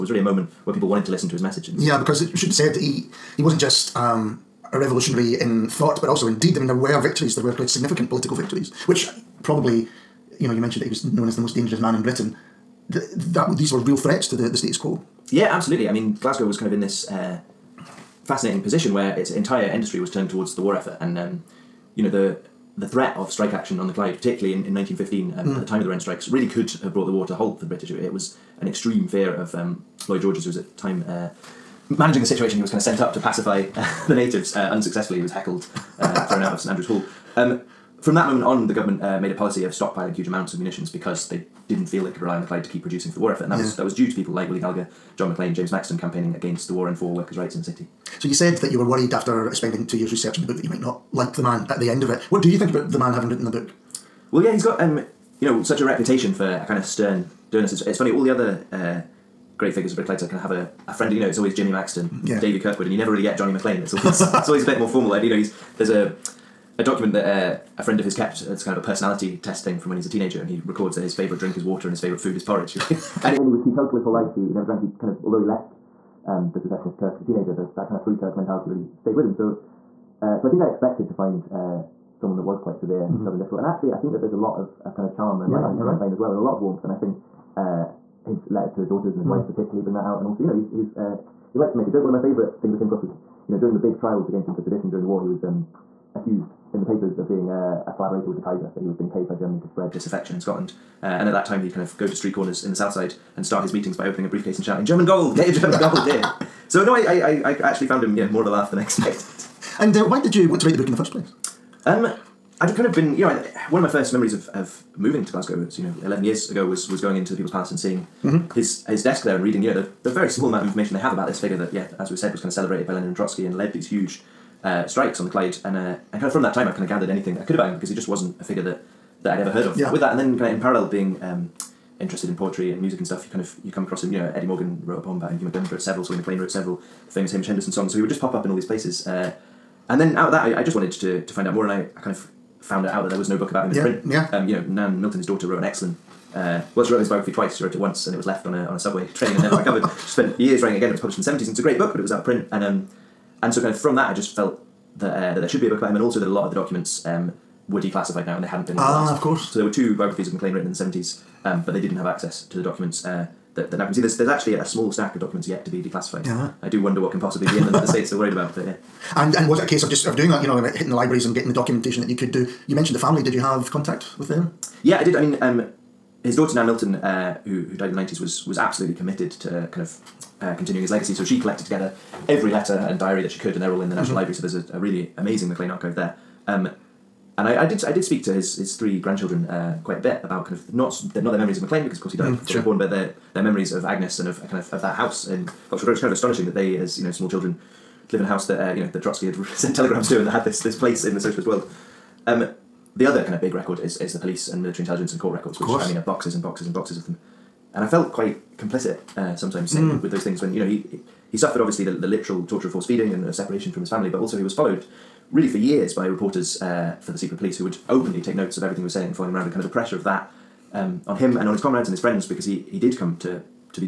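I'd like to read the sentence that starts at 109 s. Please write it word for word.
And uh, why did you want to write the book in the first place?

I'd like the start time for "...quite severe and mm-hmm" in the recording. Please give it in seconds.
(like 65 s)
82 s.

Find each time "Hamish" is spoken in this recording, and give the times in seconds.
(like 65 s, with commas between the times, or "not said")
137 s.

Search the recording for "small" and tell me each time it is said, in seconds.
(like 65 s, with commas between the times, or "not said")
120 s, 164 s, 197 s.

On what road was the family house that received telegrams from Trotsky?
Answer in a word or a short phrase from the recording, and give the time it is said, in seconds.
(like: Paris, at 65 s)
Cotswold Road, at 195 s.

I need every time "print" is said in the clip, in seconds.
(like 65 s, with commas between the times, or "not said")
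143 s, 152 s.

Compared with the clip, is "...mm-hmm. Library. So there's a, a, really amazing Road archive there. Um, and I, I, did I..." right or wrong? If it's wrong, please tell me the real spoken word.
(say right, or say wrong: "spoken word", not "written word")
wrong: "Maclean", not "Road".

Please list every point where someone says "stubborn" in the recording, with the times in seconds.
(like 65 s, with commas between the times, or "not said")
83 s.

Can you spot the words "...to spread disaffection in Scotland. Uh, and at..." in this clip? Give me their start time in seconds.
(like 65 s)
99 s.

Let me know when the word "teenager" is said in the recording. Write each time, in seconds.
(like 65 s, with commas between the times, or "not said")
70 s, 77 s.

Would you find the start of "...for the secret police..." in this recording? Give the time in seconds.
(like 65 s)
217 s.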